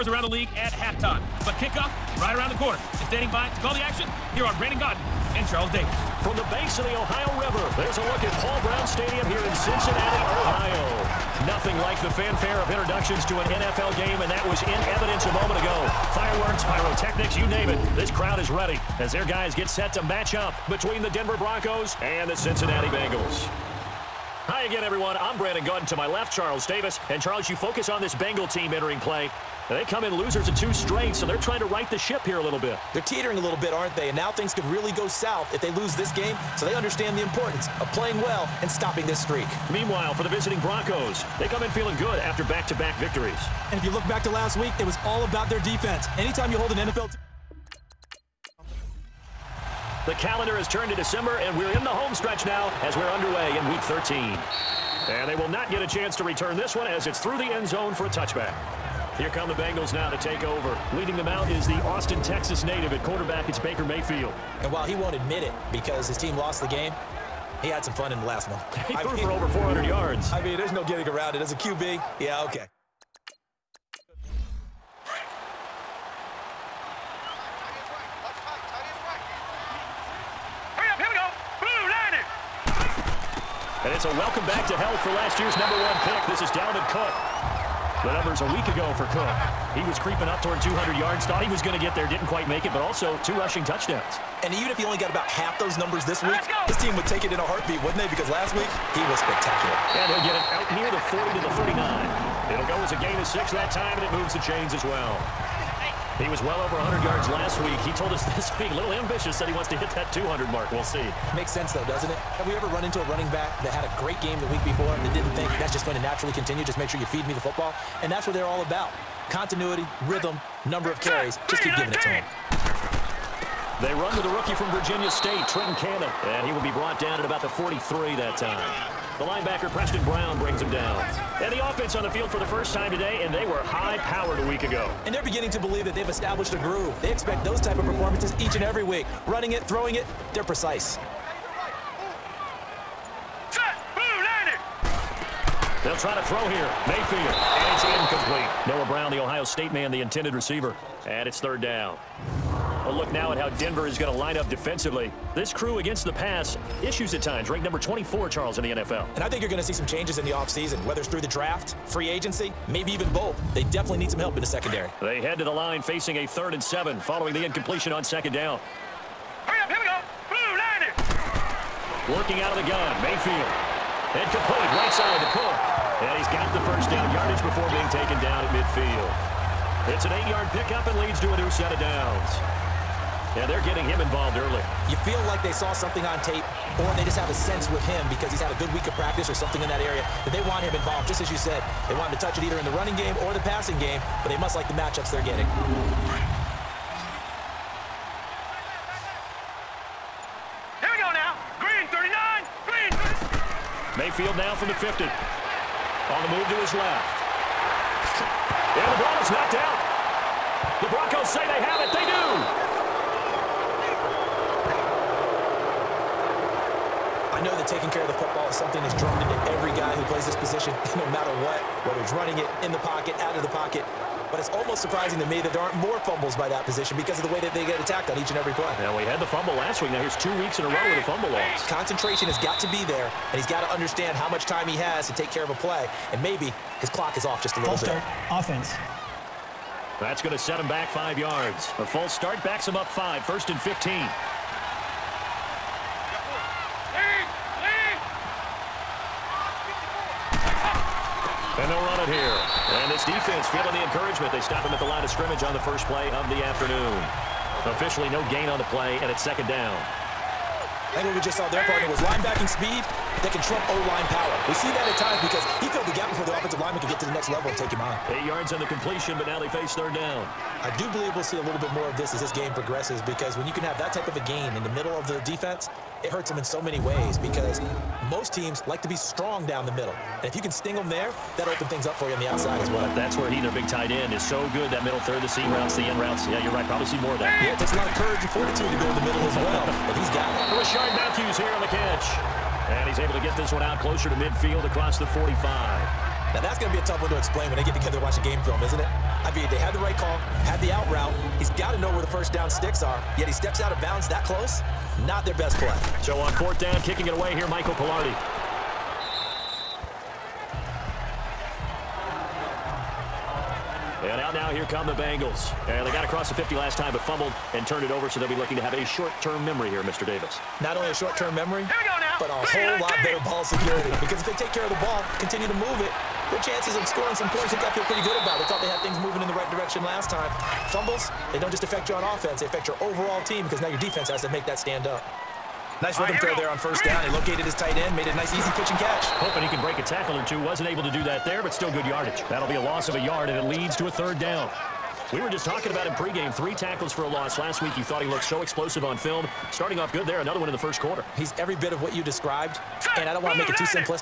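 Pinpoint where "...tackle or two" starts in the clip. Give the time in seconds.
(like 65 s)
339 s.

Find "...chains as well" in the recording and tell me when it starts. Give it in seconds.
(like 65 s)
104 s.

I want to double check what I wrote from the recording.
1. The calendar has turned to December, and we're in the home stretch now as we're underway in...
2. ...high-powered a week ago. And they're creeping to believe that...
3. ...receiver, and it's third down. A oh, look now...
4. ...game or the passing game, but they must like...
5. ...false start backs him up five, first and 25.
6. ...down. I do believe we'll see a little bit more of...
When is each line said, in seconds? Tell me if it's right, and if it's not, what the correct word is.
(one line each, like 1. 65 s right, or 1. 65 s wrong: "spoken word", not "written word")
1. 50 s right
2. 133 s wrong: "beginning", not "creeping"
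3. 150 s right
4. 192 s right
5. 241 s wrong: "15", not "25"
6. 269 s right.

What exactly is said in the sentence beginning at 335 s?
Nice rhythm throw there on first down.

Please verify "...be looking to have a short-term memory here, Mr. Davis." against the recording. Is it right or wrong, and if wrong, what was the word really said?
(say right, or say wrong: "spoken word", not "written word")
right.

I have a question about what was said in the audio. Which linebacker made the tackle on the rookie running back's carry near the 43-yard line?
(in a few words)
Preston Brown.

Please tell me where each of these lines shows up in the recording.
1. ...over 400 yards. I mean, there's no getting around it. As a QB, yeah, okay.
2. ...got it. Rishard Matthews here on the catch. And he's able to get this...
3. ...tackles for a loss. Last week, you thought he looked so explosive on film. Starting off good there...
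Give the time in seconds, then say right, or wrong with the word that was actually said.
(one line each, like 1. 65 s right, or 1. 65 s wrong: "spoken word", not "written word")
1. 69 s right
2. 290 s right
3. 346 s right.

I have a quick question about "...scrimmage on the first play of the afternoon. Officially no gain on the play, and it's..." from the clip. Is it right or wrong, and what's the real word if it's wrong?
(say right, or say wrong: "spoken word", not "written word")
right.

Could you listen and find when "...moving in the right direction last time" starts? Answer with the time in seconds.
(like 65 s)
329 s.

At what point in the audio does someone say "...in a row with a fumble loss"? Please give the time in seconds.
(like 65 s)
230 s.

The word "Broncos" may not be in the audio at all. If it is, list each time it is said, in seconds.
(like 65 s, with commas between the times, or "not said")
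21 s, 40 s, 210 s.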